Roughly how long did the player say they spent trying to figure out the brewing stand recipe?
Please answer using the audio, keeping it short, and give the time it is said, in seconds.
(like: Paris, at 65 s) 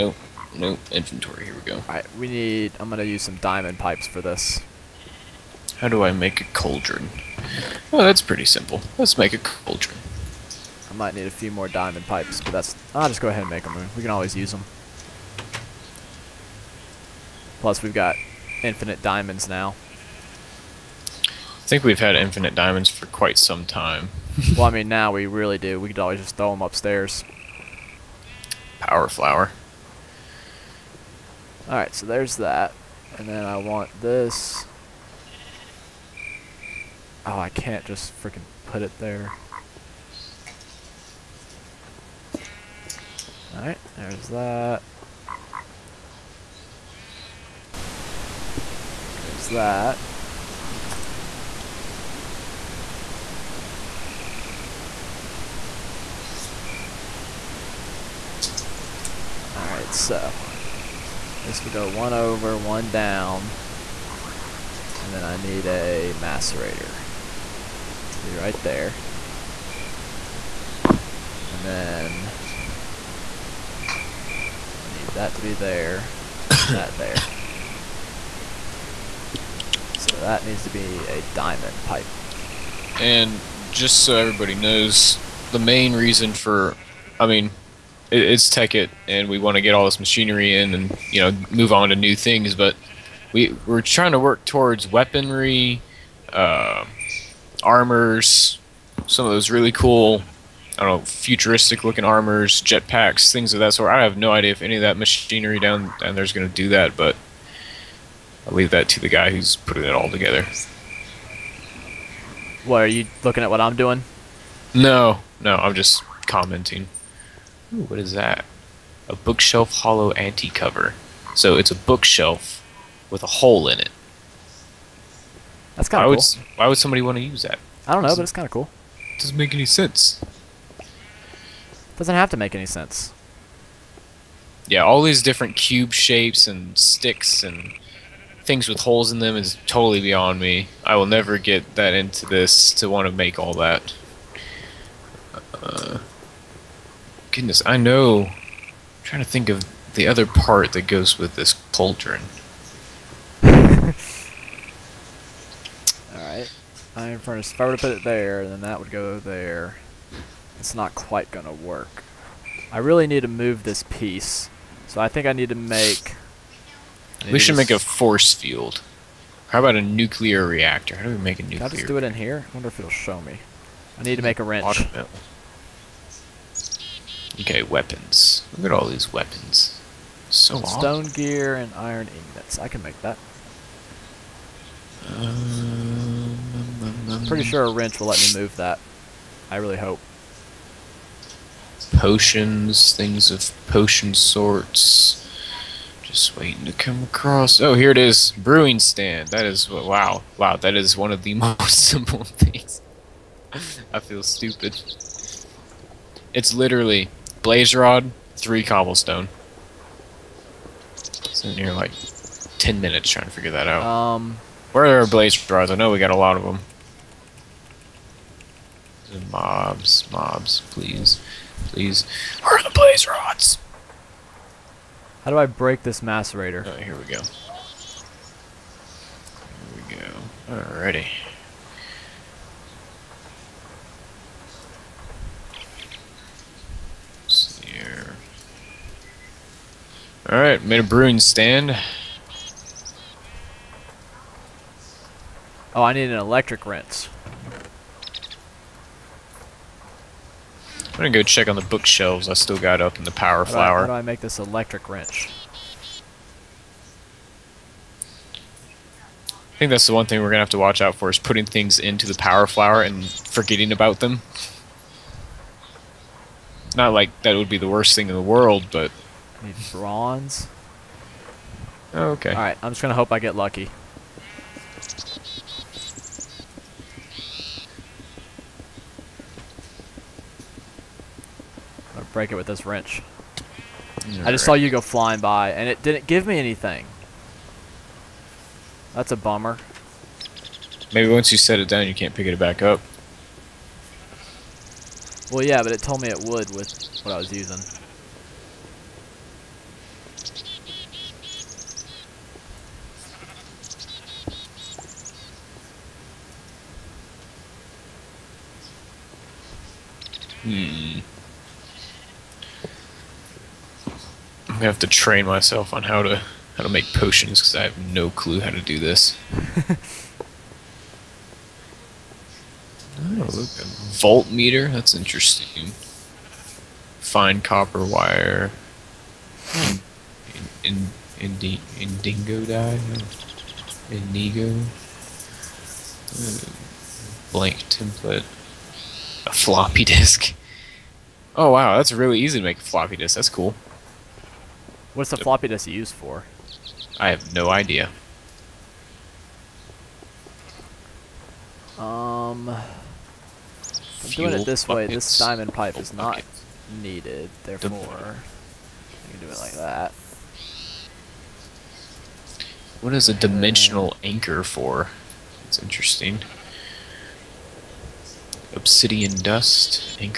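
10 minutes, at 212 s.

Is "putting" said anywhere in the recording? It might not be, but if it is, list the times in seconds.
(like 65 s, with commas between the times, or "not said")
109 s, 261 s.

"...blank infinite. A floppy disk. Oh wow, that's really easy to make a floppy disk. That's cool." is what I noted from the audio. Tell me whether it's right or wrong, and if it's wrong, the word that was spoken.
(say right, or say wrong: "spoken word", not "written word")
wrong: "template", not "infinite".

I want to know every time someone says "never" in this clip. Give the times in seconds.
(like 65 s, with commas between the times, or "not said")
141 s.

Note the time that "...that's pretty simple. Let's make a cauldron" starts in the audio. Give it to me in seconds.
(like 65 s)
8 s.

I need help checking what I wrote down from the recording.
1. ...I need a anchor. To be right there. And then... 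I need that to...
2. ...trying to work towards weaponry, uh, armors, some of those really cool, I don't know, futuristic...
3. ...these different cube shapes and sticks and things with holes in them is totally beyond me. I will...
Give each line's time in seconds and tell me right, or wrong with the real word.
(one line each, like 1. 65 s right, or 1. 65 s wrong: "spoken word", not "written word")
1. 65 s wrong: "macerator", not "anchor"
2. 93 s right
3. 135 s right.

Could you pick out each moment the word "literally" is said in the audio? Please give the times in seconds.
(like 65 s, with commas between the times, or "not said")
206 s.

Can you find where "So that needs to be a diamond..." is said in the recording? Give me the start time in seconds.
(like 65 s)
79 s.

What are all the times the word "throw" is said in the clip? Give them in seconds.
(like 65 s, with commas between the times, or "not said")
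26 s.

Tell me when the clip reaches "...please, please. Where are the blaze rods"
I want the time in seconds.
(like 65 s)
220 s.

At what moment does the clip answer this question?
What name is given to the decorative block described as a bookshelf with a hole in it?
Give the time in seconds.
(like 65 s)
119 s.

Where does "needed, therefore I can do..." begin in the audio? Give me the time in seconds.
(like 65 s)
356 s.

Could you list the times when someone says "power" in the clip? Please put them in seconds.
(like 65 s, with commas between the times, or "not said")
28 s, 253 s, 262 s.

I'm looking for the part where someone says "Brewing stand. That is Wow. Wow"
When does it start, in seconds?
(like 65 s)
198 s.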